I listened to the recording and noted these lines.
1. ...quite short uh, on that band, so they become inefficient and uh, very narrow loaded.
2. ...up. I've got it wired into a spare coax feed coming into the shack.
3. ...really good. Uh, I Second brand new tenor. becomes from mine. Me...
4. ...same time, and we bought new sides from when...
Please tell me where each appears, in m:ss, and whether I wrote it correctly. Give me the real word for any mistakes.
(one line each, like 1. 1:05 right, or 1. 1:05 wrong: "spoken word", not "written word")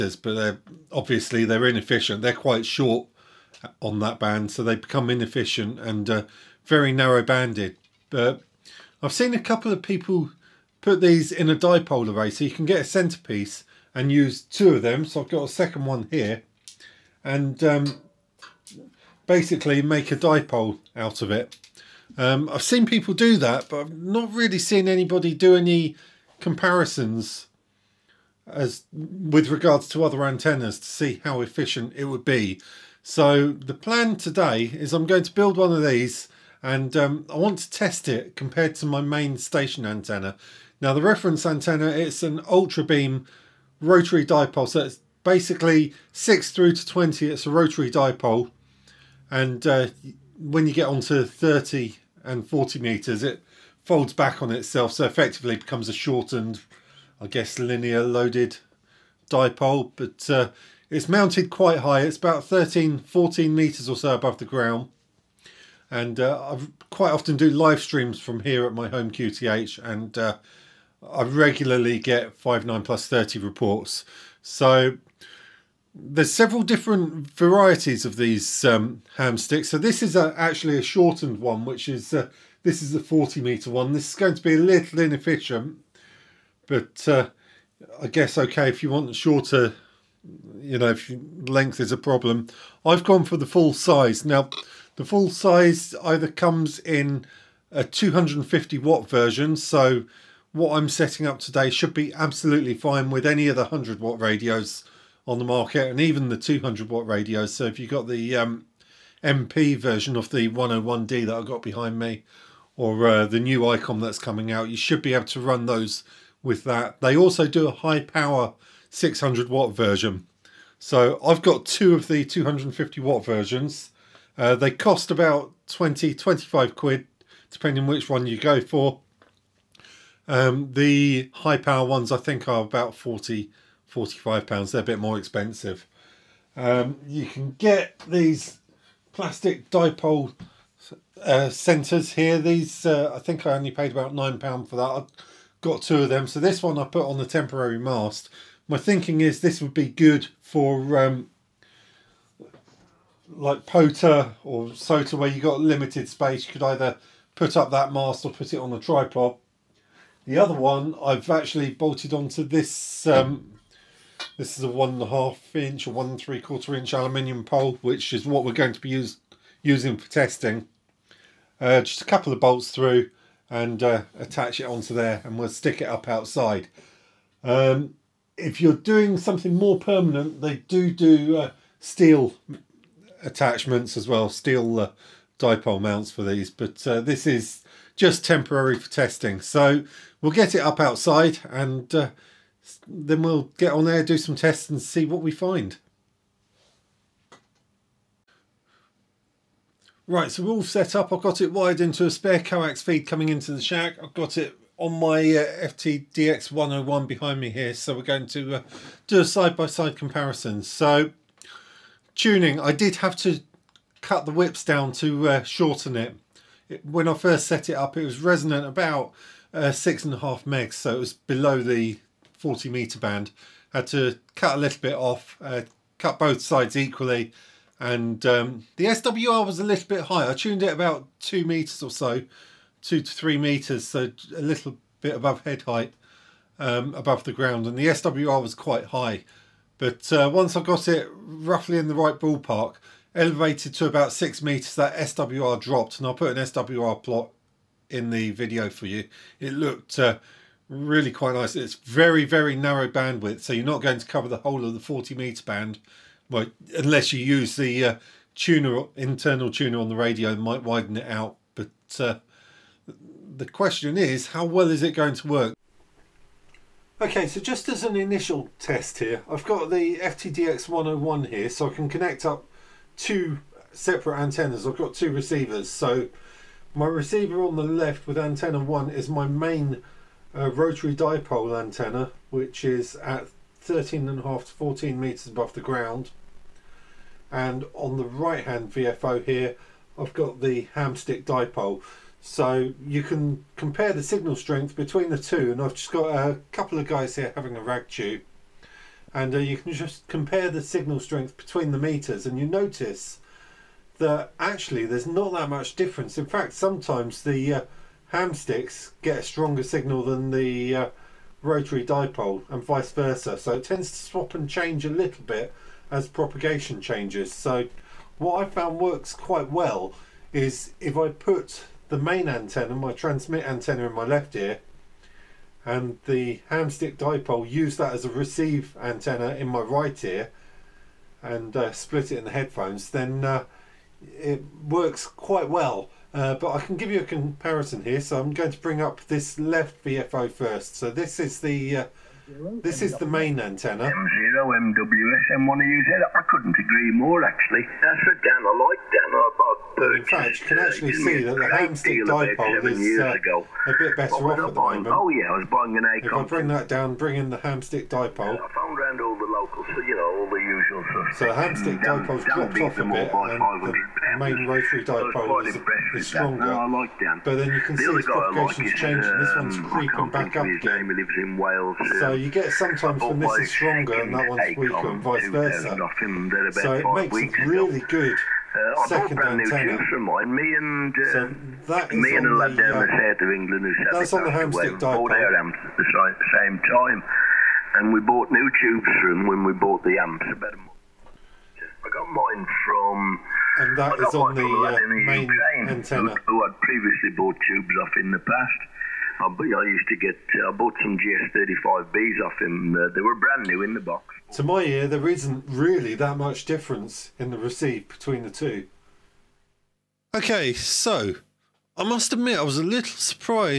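1. 0:02 wrong: "banded", not "loaded"
2. 3:20 right
3. 6:17 wrong: "tunes", not "becomes"
4. 6:26 wrong: "tubes", not "sides".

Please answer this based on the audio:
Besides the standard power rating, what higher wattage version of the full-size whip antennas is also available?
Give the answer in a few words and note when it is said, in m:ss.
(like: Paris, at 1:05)
600 watt, at 1:58.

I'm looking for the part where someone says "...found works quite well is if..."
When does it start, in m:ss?
5:18.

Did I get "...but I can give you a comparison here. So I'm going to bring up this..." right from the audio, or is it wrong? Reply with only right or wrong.
right.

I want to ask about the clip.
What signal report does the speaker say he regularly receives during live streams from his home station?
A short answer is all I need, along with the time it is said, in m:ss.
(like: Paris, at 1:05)
5 9 plus 30, at 1:12.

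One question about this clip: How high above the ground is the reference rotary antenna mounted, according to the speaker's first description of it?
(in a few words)
13 to 14 meters.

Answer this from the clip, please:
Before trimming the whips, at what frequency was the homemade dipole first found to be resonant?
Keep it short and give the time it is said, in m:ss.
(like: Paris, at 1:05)
6.5 MHz, at 3:39.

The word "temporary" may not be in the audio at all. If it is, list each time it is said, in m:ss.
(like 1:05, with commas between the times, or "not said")
2:27, 3:08.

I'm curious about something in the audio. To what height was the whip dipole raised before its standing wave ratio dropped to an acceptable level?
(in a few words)
6 meters.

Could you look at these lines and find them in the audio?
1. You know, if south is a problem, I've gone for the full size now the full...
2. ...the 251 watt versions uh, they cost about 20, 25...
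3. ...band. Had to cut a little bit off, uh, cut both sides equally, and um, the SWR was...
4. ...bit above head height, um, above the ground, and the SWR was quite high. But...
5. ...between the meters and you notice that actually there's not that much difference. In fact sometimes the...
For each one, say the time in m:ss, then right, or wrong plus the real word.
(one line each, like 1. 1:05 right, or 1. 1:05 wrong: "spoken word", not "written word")
1. 1:30 wrong: "length", not "south"
2. 2:02 wrong: "250", not "251"
3. 3:42 right
4. 3:55 right
5. 5:01 right.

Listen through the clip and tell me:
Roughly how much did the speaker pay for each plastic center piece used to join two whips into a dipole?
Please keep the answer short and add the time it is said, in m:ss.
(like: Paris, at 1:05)
9 pounds, at 2:24.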